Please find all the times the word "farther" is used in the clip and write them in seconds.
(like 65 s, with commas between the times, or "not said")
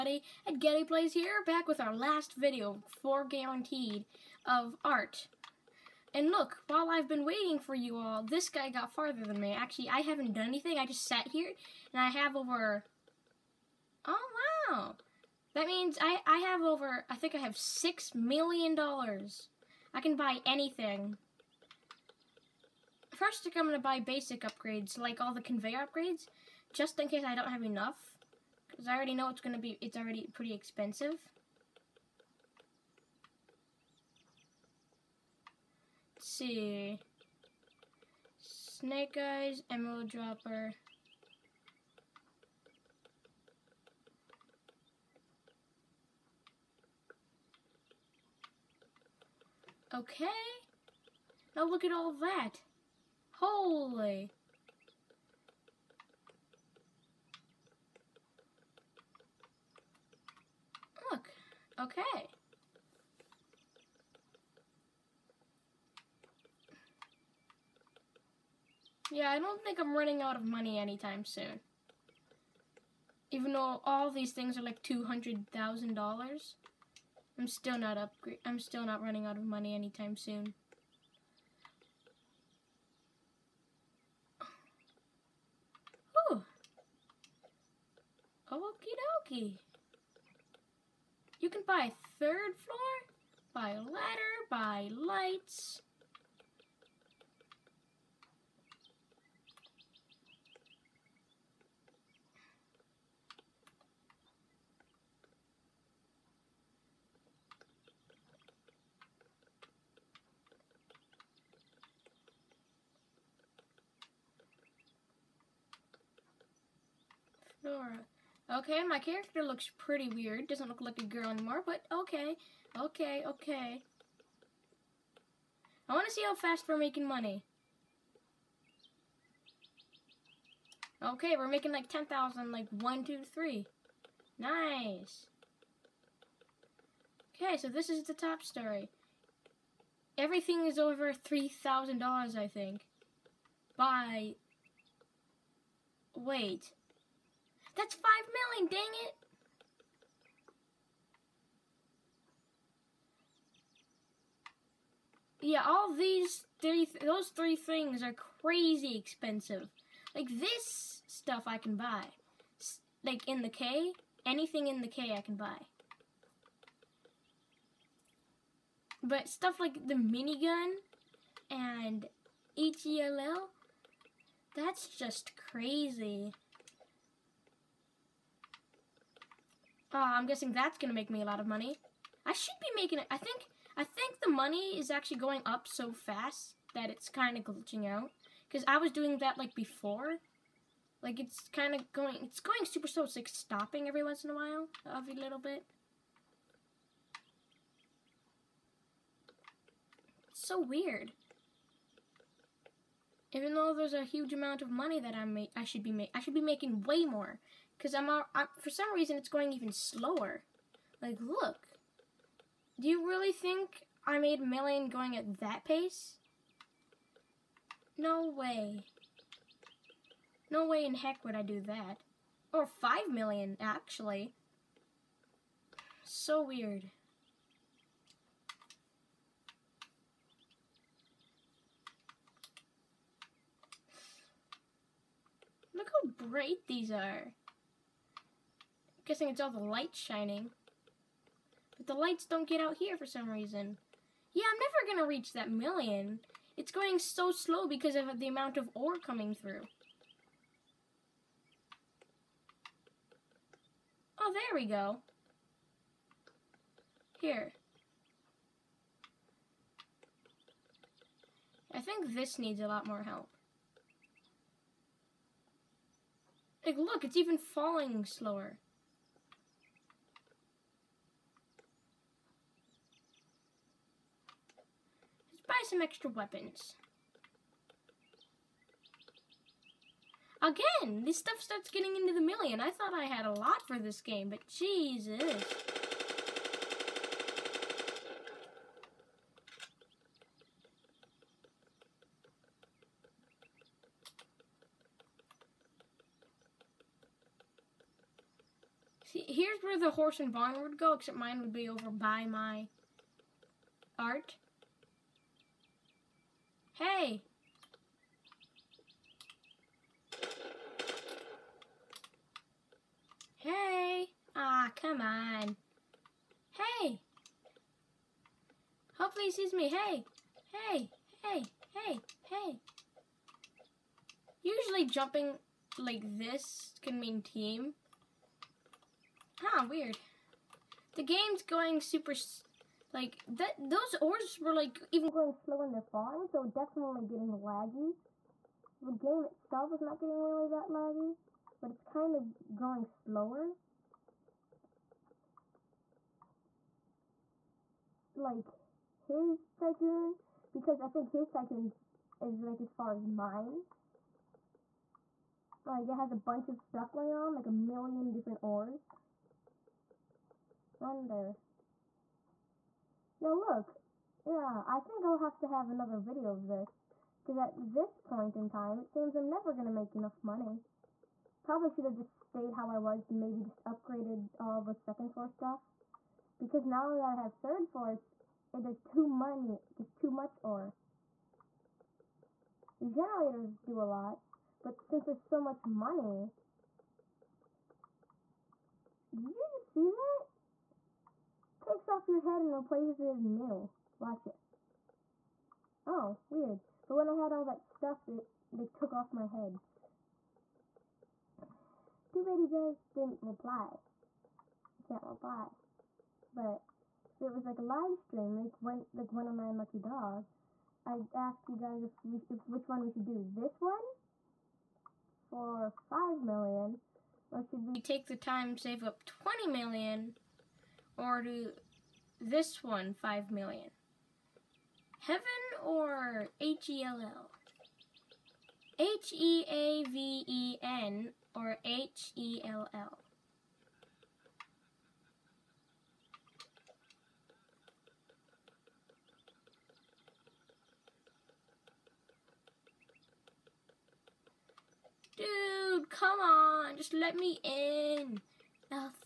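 8 s.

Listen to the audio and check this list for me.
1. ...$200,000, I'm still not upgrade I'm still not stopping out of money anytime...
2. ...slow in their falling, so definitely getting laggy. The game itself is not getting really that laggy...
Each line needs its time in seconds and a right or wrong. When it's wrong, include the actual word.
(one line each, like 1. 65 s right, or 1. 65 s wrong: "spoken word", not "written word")
1. 74 s wrong: "running", not "stopping"
2. 335 s right.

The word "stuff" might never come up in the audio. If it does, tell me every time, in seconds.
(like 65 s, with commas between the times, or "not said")
161 s, 169 s, 281 s, 356 s, 375 s, 397 s.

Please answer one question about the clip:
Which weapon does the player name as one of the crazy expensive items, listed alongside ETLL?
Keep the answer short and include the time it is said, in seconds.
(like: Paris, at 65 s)
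minigun, at 169 s.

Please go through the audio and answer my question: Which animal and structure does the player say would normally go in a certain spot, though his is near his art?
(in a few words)
horse and barn.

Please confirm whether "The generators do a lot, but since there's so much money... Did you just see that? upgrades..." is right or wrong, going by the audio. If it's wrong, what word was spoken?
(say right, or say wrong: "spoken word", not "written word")
wrong: "takes", not "upgrades".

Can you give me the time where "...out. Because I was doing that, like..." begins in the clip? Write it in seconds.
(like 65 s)
187 s.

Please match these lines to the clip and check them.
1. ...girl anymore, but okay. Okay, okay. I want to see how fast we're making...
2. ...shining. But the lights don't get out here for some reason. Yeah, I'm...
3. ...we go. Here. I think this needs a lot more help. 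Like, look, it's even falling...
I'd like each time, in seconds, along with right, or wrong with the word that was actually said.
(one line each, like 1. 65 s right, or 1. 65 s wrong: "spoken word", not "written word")
1. 121 s right
2. 239 s right
3. 254 s right.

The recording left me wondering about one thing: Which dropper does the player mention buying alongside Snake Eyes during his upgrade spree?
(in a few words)
Emerald Dropper.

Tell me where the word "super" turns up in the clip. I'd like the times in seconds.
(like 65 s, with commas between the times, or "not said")
192 s, 331 s.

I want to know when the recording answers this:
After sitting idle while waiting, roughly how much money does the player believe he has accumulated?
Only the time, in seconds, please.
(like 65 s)
17 s.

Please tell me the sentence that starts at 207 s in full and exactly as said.
Because I'm, I'm, for some reason, it's going even slower.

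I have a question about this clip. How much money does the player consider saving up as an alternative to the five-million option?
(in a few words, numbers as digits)
20 million.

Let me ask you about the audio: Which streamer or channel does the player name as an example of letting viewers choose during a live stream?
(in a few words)
109 Lucky Dog.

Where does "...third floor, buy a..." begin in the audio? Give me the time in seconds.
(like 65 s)
92 s.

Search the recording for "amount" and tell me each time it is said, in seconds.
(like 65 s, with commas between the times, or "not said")
204 s, 248 s.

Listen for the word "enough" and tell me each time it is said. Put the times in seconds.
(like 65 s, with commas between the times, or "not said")
27 s, 369 s.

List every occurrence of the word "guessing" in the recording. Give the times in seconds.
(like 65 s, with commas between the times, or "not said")
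180 s, 239 s.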